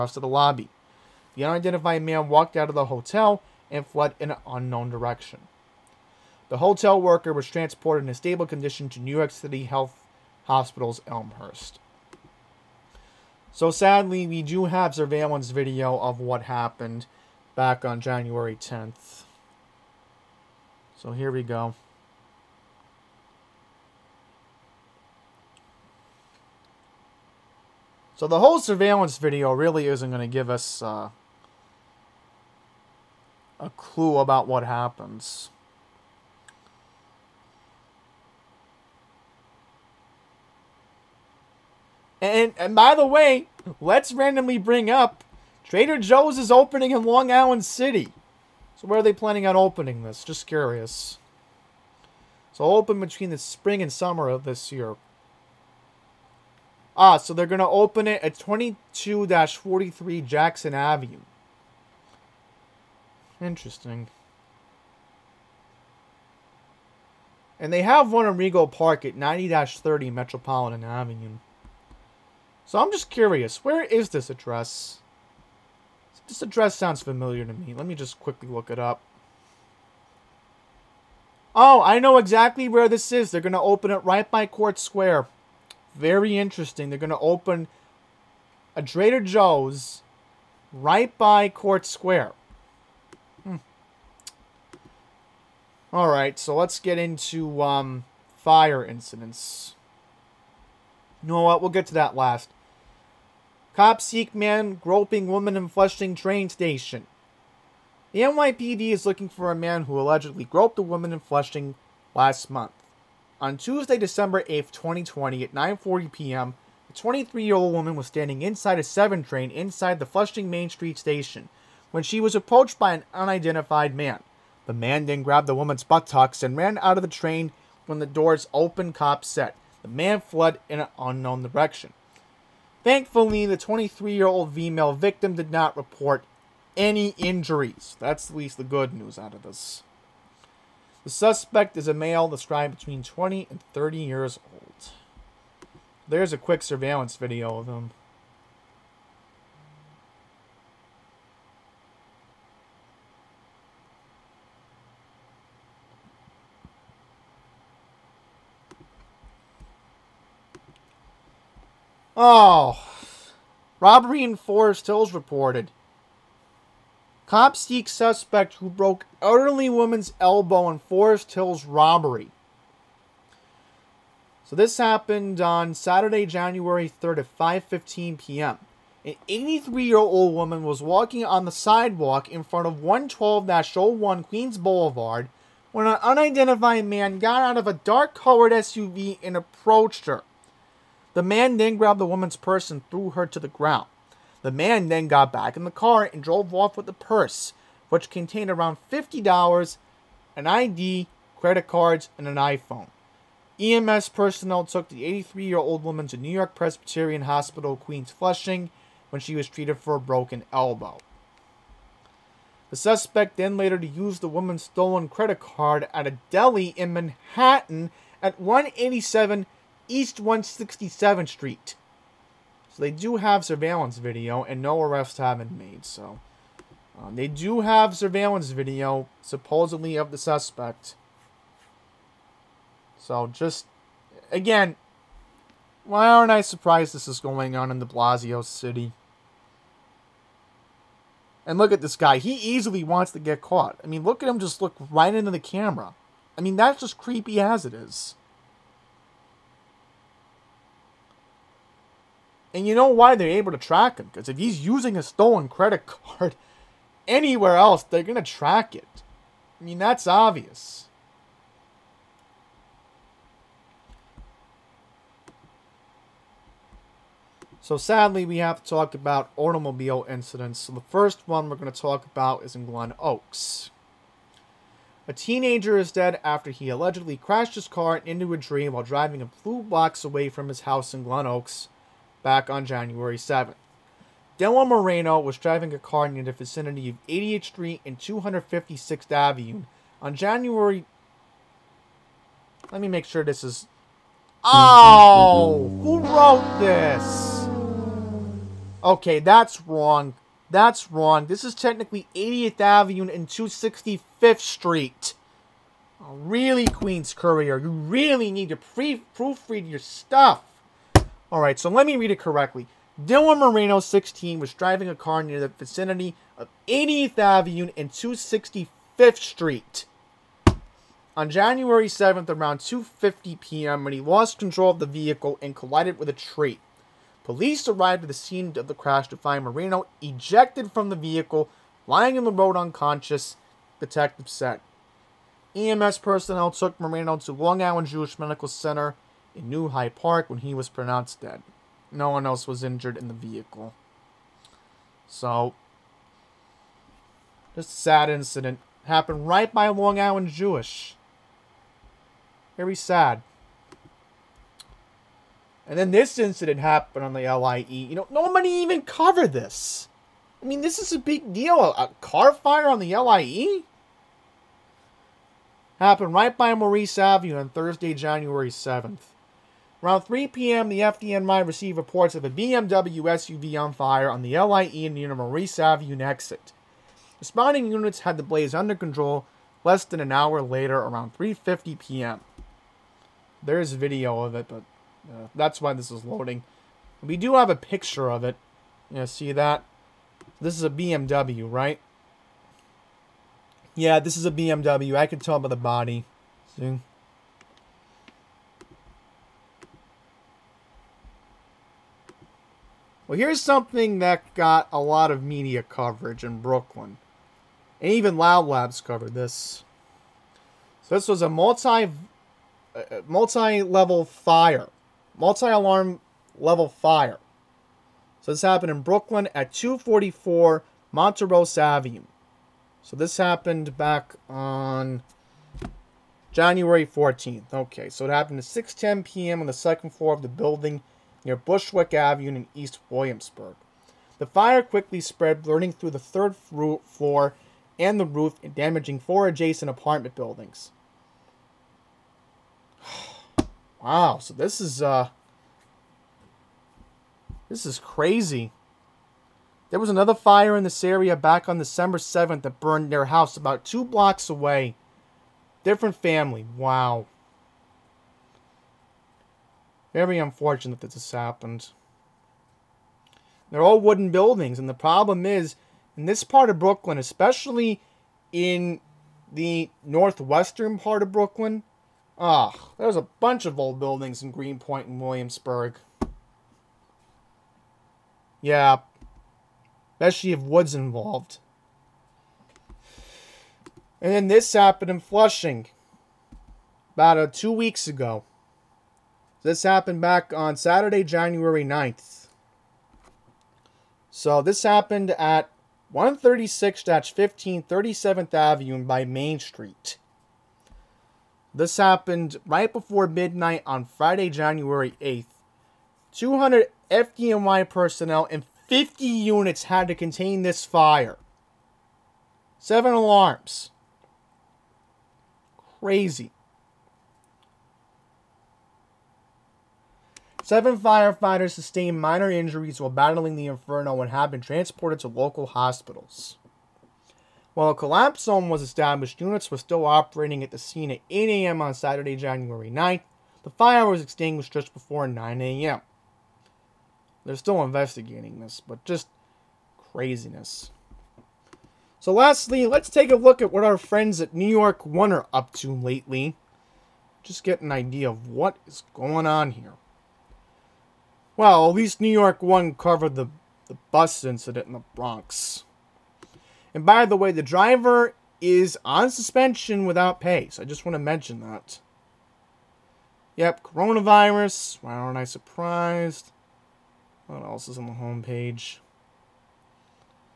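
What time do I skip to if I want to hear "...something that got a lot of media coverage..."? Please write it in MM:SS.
06:43.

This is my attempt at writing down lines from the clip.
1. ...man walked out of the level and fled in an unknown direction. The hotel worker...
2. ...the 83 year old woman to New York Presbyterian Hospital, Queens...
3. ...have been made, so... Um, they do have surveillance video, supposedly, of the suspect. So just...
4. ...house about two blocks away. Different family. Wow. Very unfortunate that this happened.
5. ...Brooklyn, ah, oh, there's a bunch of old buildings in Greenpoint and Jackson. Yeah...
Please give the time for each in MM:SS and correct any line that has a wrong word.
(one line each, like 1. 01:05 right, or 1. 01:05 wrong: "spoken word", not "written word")
1. 00:02 wrong: "hotel", not "level"
2. 03:24 right
3. 03:45 right
4. 07:33 right
5. 07:51 wrong: "Williamsburg", not "Jackson".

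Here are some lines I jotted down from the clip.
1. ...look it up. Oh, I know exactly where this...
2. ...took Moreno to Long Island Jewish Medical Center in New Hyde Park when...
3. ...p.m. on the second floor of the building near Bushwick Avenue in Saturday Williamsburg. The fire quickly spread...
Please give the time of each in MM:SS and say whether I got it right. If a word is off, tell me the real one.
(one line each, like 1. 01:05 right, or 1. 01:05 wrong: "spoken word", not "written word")
1. 01:18 right
2. 05:36 right
3. 07:09 wrong: "East", not "Saturday".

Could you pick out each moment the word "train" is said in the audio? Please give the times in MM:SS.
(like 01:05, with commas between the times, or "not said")
01:46, 01:59, 02:07.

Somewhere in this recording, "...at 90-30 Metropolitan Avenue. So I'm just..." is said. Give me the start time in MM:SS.
01:09.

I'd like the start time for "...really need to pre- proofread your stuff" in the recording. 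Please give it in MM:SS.
05:07.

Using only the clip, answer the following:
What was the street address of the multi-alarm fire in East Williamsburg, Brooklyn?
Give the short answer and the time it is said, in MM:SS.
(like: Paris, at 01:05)
244 Montrose Avenue, at 06:59.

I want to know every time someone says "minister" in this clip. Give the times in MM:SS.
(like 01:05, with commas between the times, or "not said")
not said.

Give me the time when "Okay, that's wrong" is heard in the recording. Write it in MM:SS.
04:58.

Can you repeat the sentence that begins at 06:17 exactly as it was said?
Responding units had the blaze under control less than an hour later around 3.50 p.m.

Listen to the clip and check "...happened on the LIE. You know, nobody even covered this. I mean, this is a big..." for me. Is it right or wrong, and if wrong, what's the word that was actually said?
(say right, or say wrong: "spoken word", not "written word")
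right.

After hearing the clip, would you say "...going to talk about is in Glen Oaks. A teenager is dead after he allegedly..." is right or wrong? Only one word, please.
right.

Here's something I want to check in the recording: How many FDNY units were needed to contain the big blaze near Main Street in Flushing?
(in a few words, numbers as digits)
50.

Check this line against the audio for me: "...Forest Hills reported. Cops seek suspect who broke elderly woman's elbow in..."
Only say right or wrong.
right.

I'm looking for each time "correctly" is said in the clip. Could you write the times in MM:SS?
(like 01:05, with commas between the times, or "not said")
05:12.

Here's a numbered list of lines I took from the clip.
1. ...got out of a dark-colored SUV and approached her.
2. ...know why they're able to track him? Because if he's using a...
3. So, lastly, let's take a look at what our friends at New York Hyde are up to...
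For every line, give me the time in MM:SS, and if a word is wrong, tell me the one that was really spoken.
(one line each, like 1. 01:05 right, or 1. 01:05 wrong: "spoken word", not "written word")
1. 03:07 right
2. 04:12 right
3. 09:01 wrong: "One", not "Hyde".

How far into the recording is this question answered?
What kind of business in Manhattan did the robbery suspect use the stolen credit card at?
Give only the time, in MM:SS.
03:36.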